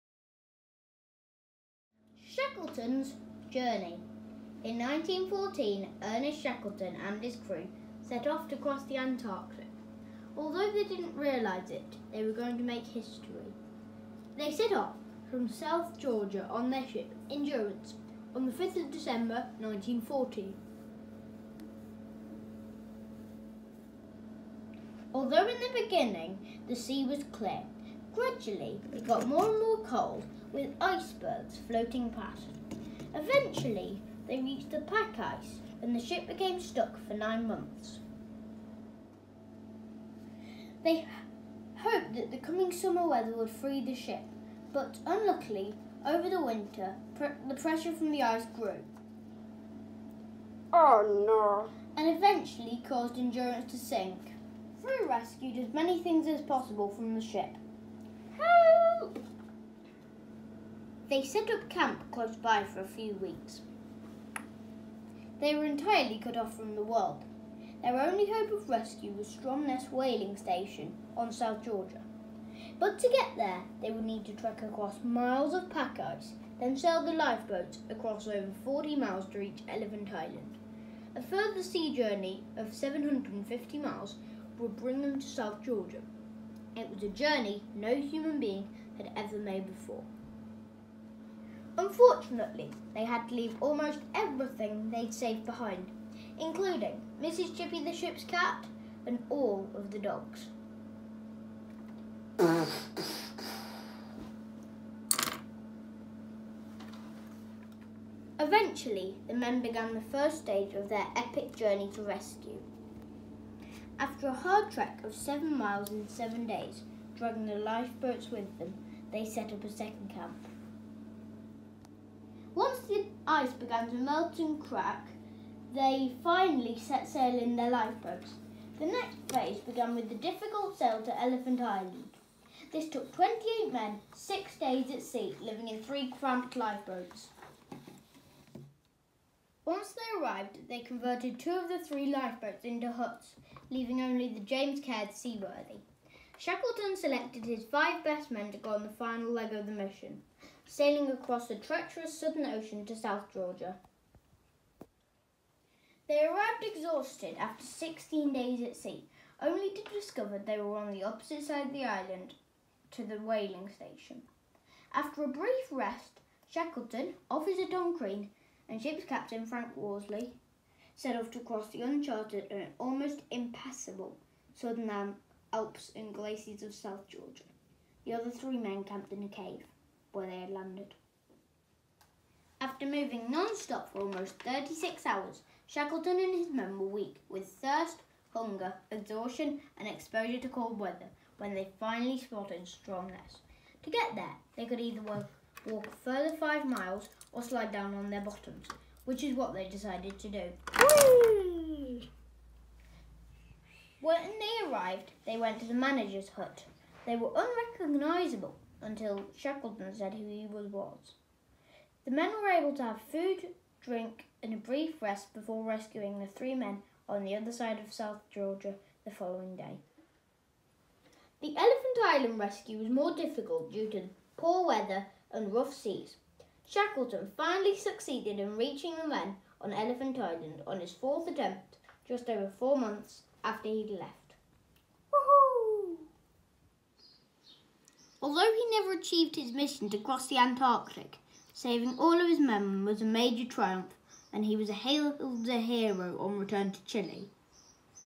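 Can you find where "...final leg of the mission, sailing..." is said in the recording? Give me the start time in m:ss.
2:28.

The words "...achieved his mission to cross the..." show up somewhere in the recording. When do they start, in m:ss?
3:58.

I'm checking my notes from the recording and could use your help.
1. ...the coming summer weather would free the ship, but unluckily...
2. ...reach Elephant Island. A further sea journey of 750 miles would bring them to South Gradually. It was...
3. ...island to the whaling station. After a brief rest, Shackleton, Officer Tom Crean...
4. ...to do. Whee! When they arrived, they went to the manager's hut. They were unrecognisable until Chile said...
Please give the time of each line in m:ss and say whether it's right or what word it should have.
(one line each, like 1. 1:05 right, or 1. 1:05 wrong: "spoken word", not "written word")
1. 0:42 right
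2. 1:19 wrong: "Georgia", not "Gradually"
3. 2:41 right
4. 3:20 wrong: "Shackleton", not "Chile".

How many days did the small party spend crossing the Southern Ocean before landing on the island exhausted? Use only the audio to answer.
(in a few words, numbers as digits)
16.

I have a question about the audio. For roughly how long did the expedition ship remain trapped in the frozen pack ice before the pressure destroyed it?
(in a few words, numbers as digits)
9 months.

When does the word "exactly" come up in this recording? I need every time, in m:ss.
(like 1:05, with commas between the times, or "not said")
not said.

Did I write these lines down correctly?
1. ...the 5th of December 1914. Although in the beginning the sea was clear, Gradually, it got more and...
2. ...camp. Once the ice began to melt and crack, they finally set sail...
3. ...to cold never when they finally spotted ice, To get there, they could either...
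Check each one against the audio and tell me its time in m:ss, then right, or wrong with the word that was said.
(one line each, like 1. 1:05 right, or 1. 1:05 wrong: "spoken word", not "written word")
1. 0:18 right
2. 2:00 right
3. 3:10 wrong: "weather", not "never".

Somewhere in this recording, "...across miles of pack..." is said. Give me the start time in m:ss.
1:14.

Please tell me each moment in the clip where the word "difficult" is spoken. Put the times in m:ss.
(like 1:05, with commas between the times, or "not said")
2:10, 3:43.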